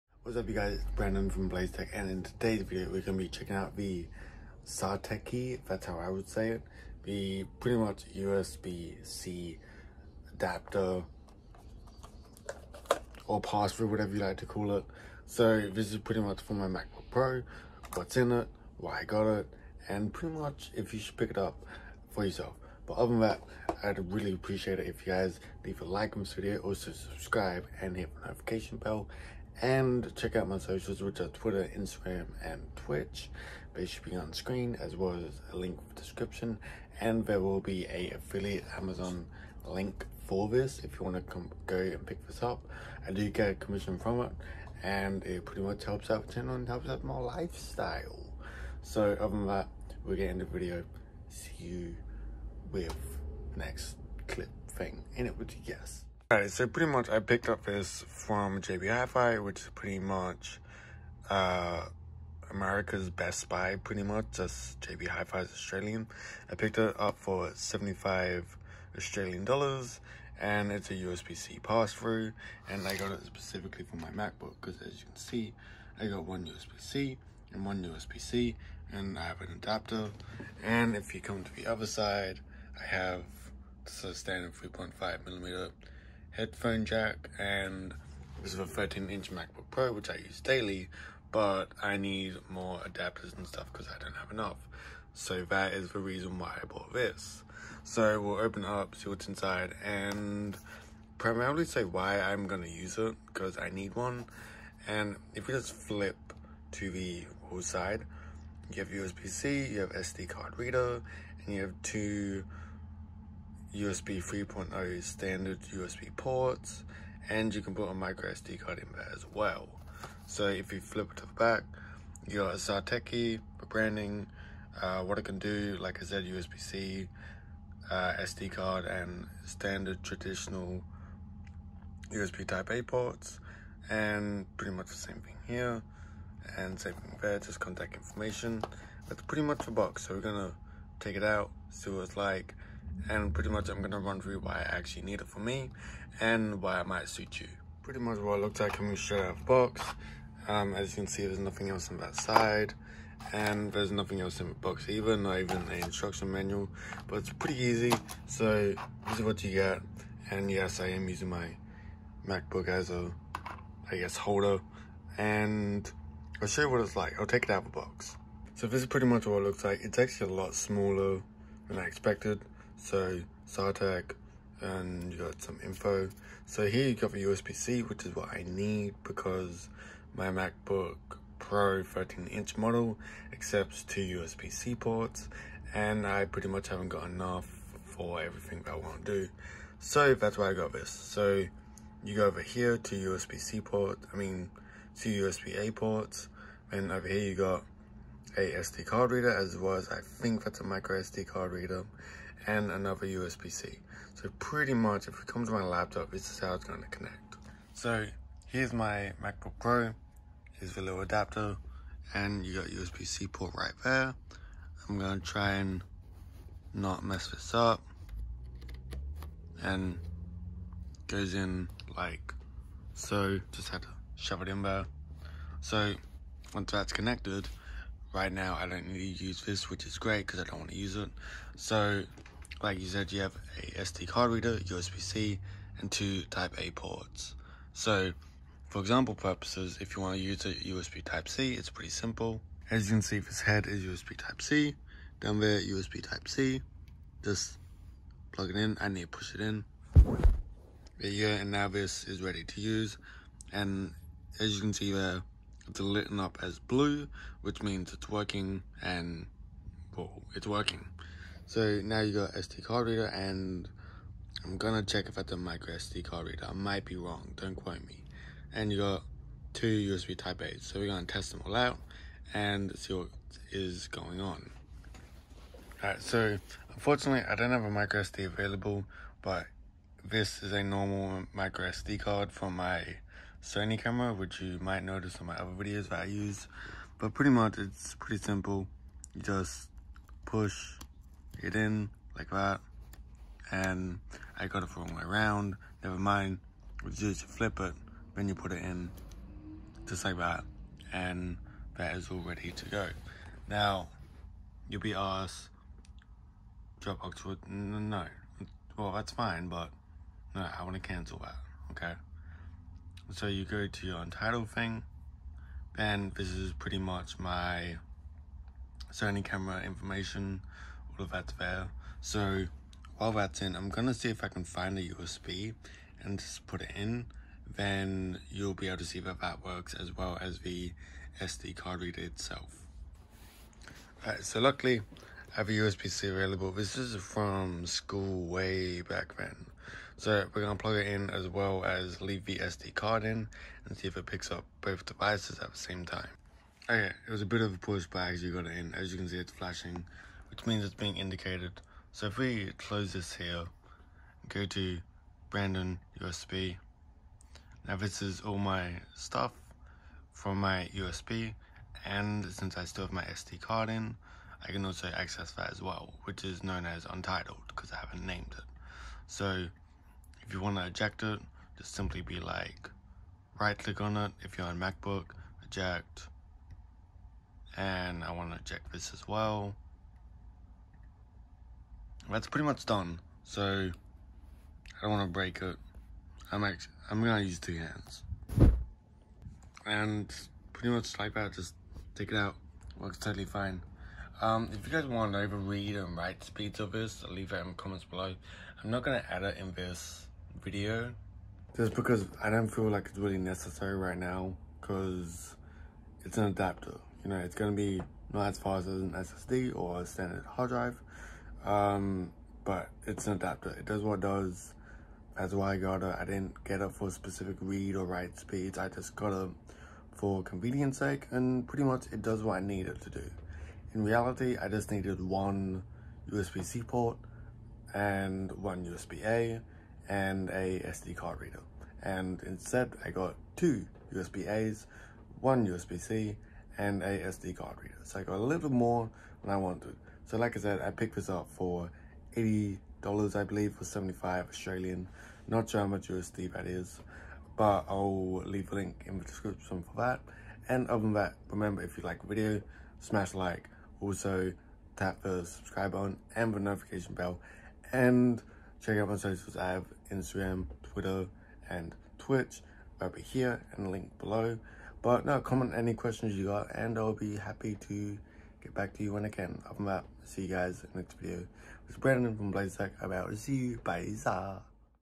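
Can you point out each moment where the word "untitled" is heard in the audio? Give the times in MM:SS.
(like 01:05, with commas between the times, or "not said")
05:13, 06:06.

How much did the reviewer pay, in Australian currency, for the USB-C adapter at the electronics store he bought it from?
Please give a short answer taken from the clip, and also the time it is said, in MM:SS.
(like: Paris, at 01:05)
75 Australian dollars, at 01:07.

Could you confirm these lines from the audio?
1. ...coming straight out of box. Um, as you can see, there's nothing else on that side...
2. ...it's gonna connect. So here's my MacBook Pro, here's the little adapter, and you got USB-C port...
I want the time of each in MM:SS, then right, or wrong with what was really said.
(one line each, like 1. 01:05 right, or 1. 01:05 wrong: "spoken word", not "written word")
1. 02:28 right
2. 03:26 right.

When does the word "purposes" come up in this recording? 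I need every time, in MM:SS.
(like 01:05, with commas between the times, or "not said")
03:59.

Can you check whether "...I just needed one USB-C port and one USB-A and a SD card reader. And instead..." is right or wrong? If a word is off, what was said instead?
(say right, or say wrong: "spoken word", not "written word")
right.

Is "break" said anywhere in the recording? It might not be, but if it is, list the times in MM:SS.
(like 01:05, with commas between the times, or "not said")
06:25.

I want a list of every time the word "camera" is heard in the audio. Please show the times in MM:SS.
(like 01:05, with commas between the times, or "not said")
04:43, 05:19.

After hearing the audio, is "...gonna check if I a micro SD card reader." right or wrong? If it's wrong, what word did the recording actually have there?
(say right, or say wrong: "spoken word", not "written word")
right.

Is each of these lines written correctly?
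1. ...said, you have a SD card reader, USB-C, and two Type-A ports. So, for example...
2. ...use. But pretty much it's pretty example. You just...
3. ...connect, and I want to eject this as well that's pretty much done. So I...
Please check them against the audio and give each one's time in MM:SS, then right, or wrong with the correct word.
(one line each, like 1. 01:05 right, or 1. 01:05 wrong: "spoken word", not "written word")
1. 03:52 right
2. 04:46 wrong: "simple", not "example"
3. 06:15 wrong: "eject", not "connect".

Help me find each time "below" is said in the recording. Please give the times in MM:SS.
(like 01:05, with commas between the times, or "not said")
06:37, 07:43.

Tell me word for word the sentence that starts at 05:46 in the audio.
Okay, it was a bit of a pushback as you got it in.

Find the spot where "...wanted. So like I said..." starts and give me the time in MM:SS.
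07:19.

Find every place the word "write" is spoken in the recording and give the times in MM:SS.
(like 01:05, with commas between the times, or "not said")
06:35, 06:57.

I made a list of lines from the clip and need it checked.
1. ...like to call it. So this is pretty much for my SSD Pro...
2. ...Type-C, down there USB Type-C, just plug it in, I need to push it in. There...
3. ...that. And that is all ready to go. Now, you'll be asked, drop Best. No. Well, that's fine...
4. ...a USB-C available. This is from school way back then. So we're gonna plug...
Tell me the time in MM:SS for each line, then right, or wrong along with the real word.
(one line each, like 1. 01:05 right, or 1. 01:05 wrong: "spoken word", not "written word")
1. 00:14 wrong: "MacBook", not "SSD"
2. 04:04 right
3. 05:00 wrong: "Oxford", not "Best"
4. 05:35 right.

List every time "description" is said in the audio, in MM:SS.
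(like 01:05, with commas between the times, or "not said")
00:35, 07:29.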